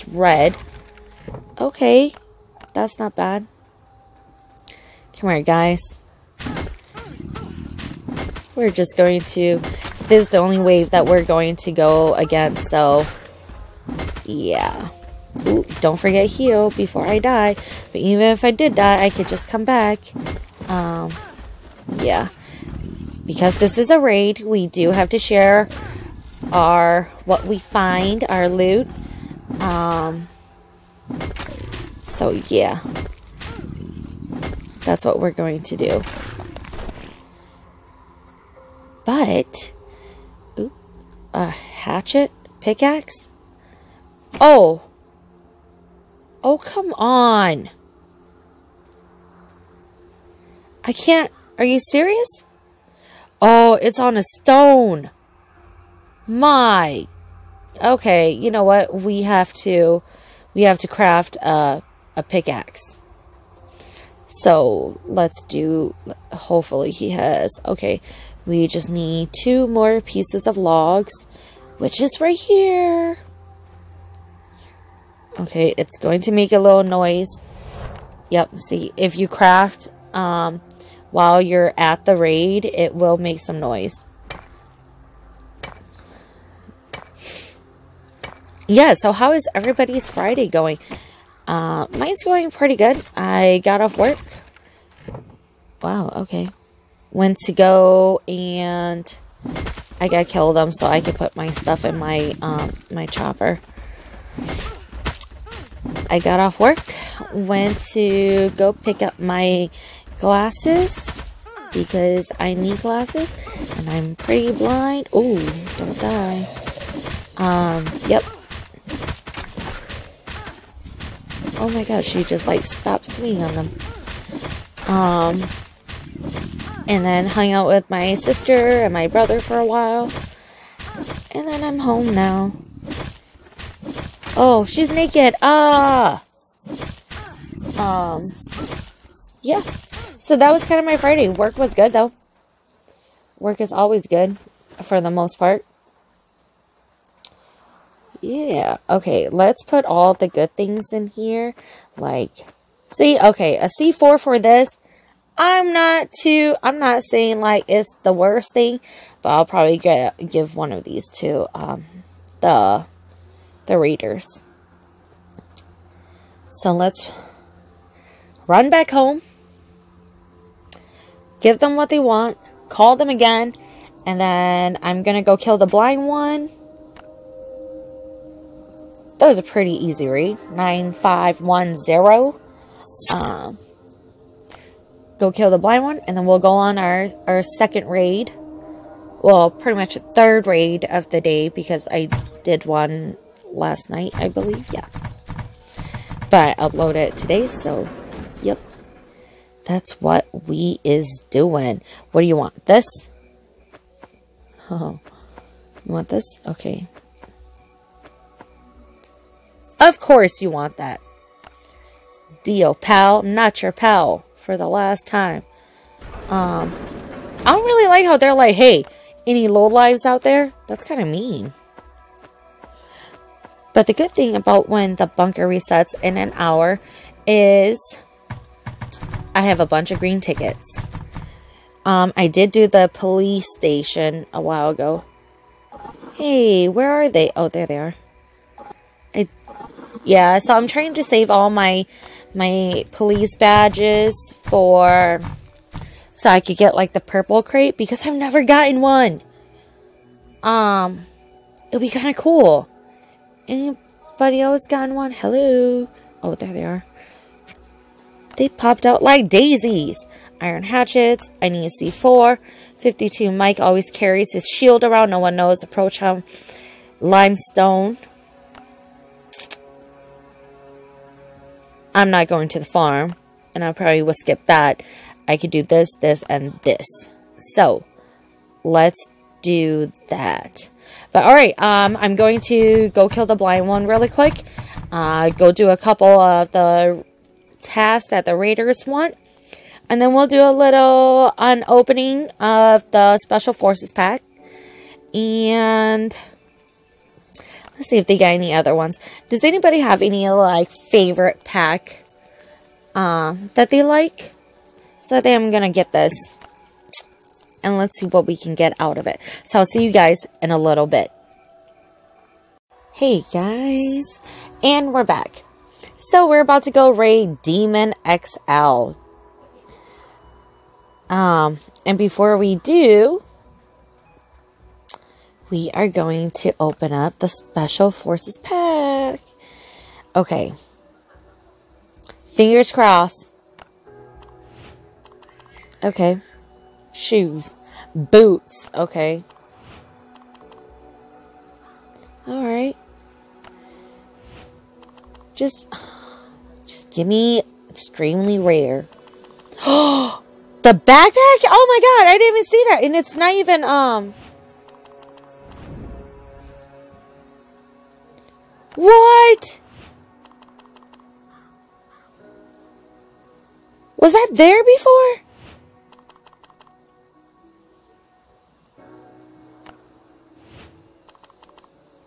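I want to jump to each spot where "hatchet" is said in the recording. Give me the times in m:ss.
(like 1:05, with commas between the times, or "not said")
0:41, 4:20.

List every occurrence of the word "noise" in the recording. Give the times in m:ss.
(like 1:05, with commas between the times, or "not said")
1:16, 1:23.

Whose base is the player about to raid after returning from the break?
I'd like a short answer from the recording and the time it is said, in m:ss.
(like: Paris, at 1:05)
Demon XL, at 5:17.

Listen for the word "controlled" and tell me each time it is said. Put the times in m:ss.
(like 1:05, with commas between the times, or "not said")
not said.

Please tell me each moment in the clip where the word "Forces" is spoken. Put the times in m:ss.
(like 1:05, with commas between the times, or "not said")
4:53, 5:27.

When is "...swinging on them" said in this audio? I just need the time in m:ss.
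2:03.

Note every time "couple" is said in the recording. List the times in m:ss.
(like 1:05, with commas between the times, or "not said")
4:45.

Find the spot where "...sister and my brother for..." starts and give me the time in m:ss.
2:08.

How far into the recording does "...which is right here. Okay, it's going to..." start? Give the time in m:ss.
1:11.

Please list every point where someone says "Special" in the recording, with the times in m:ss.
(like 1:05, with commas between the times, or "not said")
4:53, 5:27.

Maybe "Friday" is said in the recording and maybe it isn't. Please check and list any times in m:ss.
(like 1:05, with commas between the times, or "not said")
1:30, 2:20.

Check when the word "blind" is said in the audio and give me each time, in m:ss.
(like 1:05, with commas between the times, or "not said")
1:54, 2:55, 3:05, 4:43.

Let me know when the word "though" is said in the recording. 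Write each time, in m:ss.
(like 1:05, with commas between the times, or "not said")
2:21.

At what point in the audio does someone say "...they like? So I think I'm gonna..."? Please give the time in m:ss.
5:03.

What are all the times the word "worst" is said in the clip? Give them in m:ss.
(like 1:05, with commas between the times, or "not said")
2:38.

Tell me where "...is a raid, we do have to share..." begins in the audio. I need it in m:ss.
0:23.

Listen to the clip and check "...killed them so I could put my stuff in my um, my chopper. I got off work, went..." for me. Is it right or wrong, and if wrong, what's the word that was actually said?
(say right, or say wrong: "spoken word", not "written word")
right.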